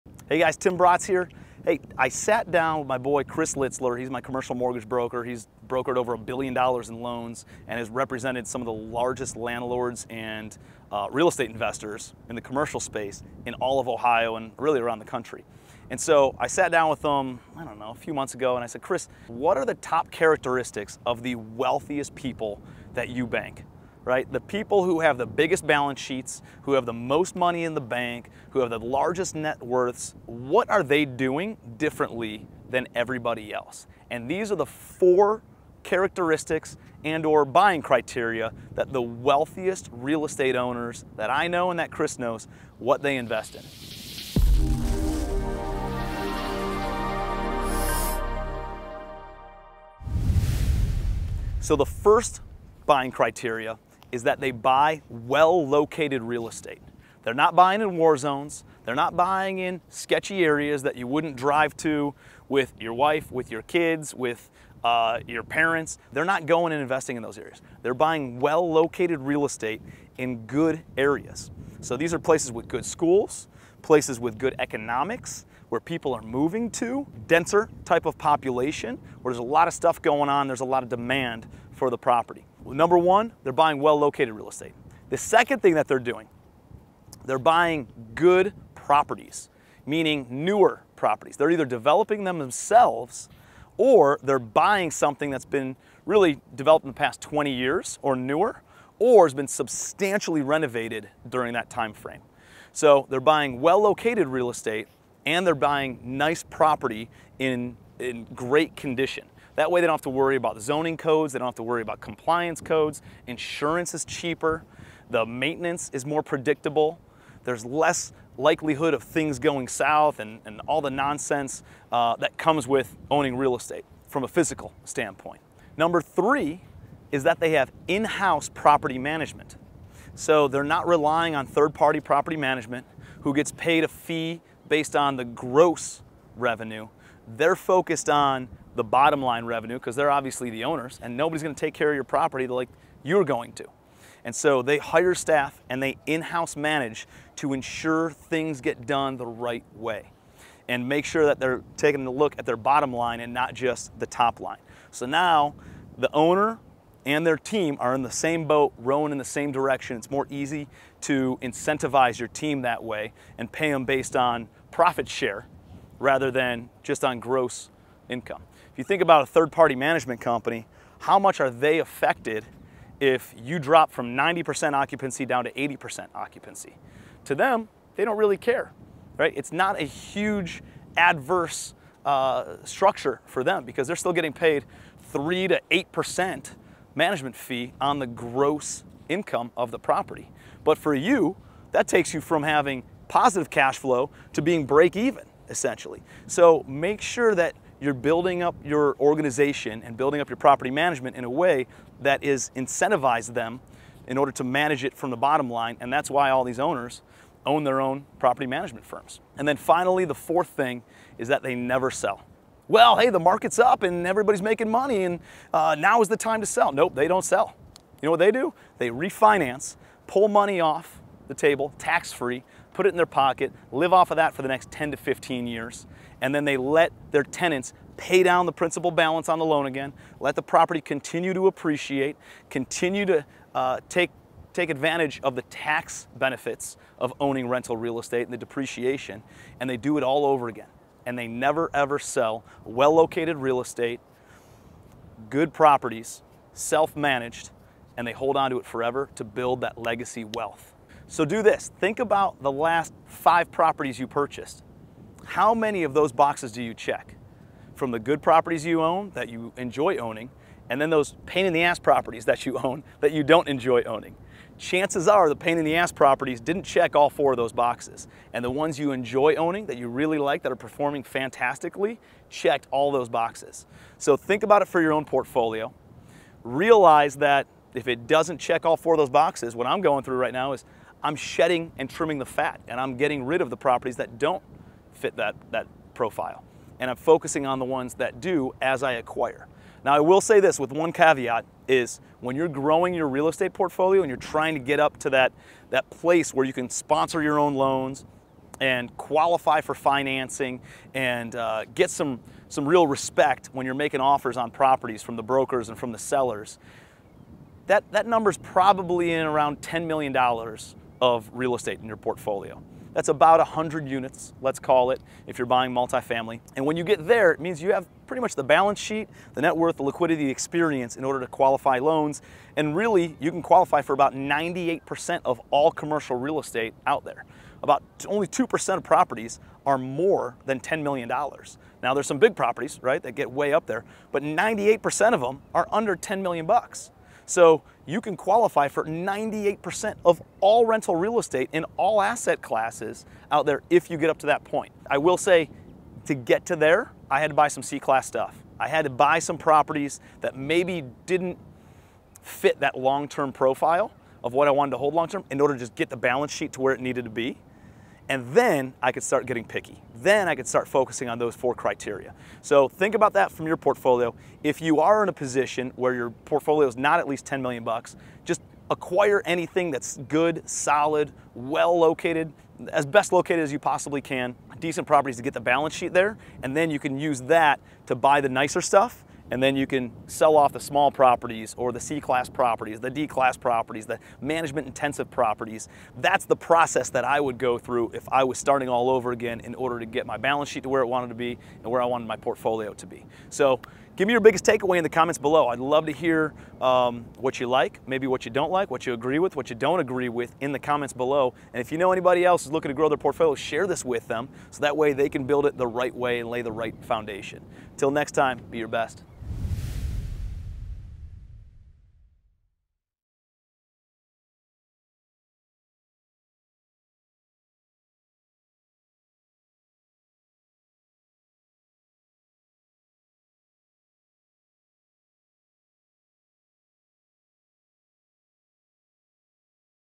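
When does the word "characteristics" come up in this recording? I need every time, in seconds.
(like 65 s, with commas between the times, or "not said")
20 s, 35 s.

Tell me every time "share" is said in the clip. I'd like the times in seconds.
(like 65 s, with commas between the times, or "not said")
165 s, 403 s.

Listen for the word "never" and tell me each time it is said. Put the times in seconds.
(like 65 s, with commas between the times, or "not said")
211 s, 241 s.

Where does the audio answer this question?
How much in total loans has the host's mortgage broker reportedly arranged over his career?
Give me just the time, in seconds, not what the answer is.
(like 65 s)
5 s.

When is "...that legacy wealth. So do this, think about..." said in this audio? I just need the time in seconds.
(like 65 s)
249 s.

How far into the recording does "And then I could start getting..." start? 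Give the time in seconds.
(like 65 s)
358 s.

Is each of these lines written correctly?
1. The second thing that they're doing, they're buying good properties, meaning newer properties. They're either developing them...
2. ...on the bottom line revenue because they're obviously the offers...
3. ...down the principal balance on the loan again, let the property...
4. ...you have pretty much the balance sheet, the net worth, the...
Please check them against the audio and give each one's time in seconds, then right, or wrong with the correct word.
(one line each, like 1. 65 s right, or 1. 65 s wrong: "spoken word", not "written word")
1. 85 s right
2. 138 s wrong: "owners", not "offers"
3. 228 s right
4. 317 s right.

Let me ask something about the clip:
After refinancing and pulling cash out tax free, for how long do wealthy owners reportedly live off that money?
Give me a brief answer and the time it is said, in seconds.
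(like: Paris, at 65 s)
10 to 15 years, at 224 s.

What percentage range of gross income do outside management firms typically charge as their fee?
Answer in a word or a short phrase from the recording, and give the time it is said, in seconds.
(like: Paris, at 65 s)
3 to 8%, at 185 s.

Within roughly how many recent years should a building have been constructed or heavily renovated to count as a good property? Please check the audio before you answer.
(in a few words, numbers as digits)
20 years.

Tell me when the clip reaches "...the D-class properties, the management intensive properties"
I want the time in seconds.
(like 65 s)
382 s.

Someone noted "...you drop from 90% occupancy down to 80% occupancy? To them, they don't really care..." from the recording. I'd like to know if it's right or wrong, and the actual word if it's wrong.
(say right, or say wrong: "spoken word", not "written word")
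right.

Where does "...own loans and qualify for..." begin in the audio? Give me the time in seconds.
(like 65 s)
297 s.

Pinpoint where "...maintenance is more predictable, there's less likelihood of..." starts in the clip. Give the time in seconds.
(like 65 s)
115 s.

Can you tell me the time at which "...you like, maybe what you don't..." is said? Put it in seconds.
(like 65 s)
397 s.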